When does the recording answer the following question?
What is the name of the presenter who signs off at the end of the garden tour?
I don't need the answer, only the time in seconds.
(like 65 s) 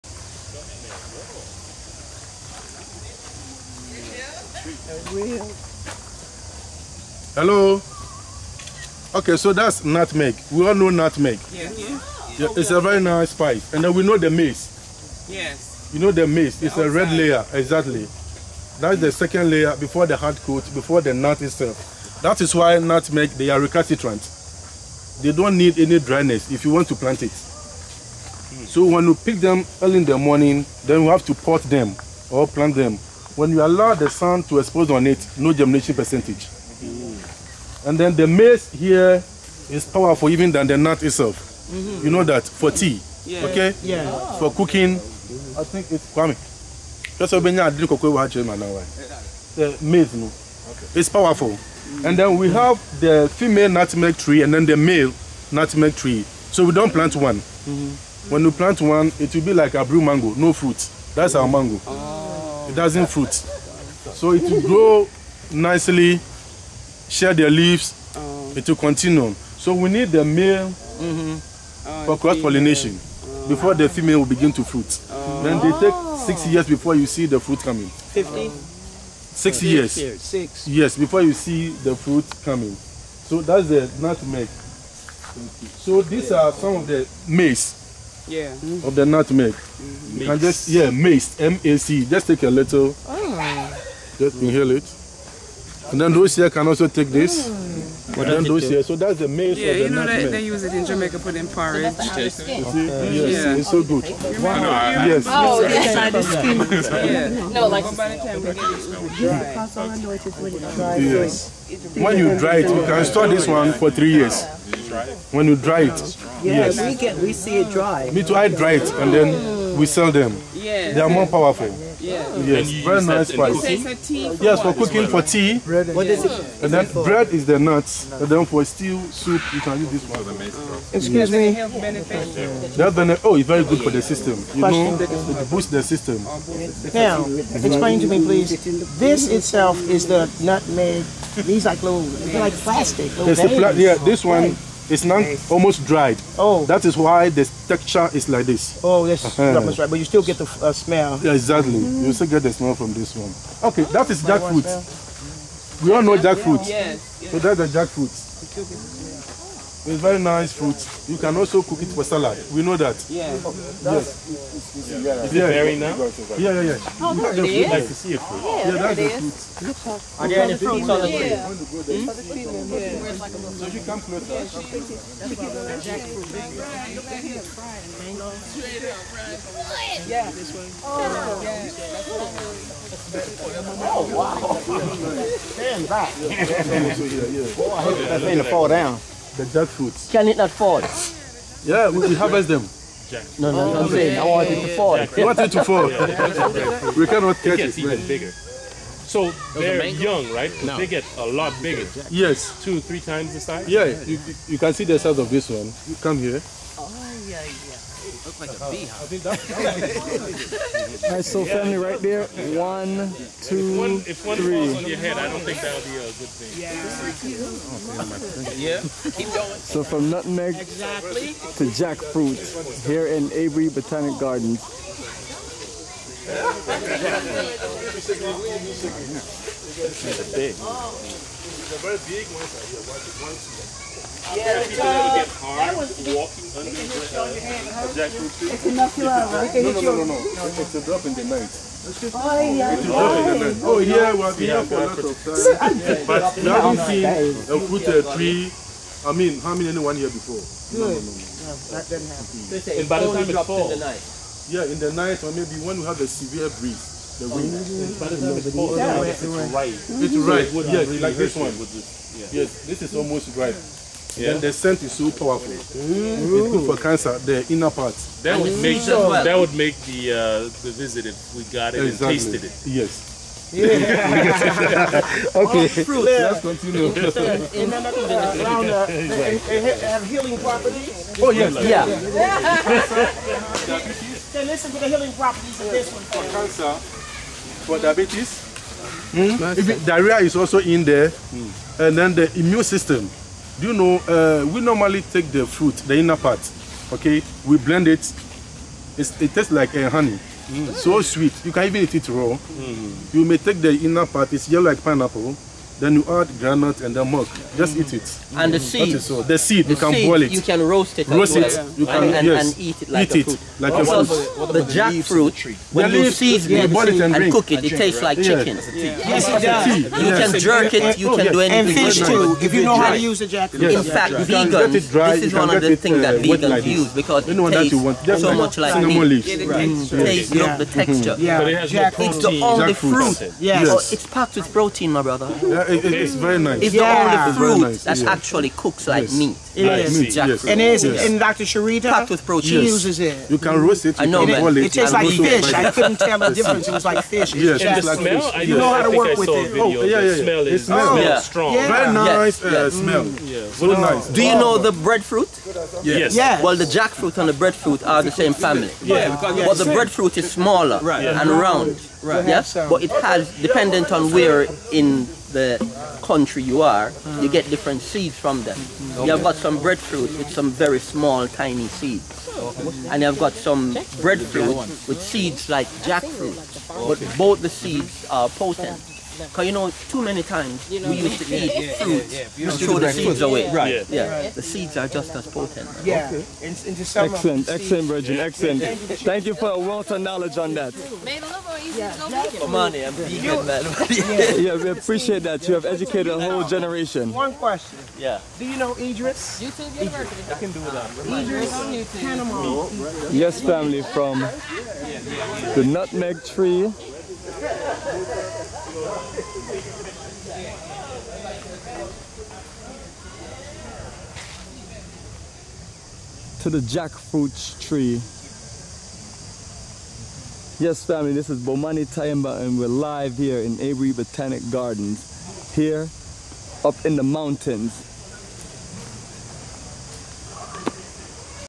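421 s.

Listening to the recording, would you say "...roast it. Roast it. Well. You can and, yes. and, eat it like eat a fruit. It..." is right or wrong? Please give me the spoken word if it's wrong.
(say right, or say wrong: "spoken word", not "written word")
right.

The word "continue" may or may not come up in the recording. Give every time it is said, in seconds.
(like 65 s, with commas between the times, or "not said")
68 s, 276 s.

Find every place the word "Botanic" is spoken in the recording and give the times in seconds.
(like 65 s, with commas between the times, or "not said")
223 s, 423 s.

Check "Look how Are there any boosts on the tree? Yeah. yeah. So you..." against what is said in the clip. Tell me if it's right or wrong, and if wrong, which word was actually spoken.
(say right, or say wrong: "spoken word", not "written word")
wrong: "fruits", not "boosts".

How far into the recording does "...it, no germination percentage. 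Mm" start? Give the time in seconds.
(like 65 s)
35 s.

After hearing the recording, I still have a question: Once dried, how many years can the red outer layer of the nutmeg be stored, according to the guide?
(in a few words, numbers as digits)
3.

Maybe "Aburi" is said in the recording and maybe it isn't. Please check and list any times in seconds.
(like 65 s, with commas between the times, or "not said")
223 s, 423 s.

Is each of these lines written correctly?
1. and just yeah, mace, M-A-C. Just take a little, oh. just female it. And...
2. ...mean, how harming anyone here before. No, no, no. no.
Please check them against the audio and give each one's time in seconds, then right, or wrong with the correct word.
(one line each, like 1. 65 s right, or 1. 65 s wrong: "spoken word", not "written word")
1. 90 s wrong: "inhale", not "female"
2. 249 s right.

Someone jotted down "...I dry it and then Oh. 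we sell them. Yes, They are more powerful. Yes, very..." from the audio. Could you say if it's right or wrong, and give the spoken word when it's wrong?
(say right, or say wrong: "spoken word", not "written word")
right.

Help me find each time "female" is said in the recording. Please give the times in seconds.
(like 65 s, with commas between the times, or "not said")
53 s, 73 s.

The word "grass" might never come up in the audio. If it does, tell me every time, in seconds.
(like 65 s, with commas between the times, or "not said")
not said.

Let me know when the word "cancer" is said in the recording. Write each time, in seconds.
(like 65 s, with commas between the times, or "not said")
266 s, 286 s.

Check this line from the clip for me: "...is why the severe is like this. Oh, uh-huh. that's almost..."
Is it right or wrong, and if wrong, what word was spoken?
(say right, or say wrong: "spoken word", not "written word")
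wrong: "texture", not "severe".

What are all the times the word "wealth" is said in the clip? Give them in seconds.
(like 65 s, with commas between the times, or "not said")
389 s.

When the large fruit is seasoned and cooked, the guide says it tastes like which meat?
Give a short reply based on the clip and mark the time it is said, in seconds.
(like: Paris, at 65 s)
Chicken, at 318 s.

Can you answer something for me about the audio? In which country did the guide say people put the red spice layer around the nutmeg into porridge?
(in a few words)
Jamaica.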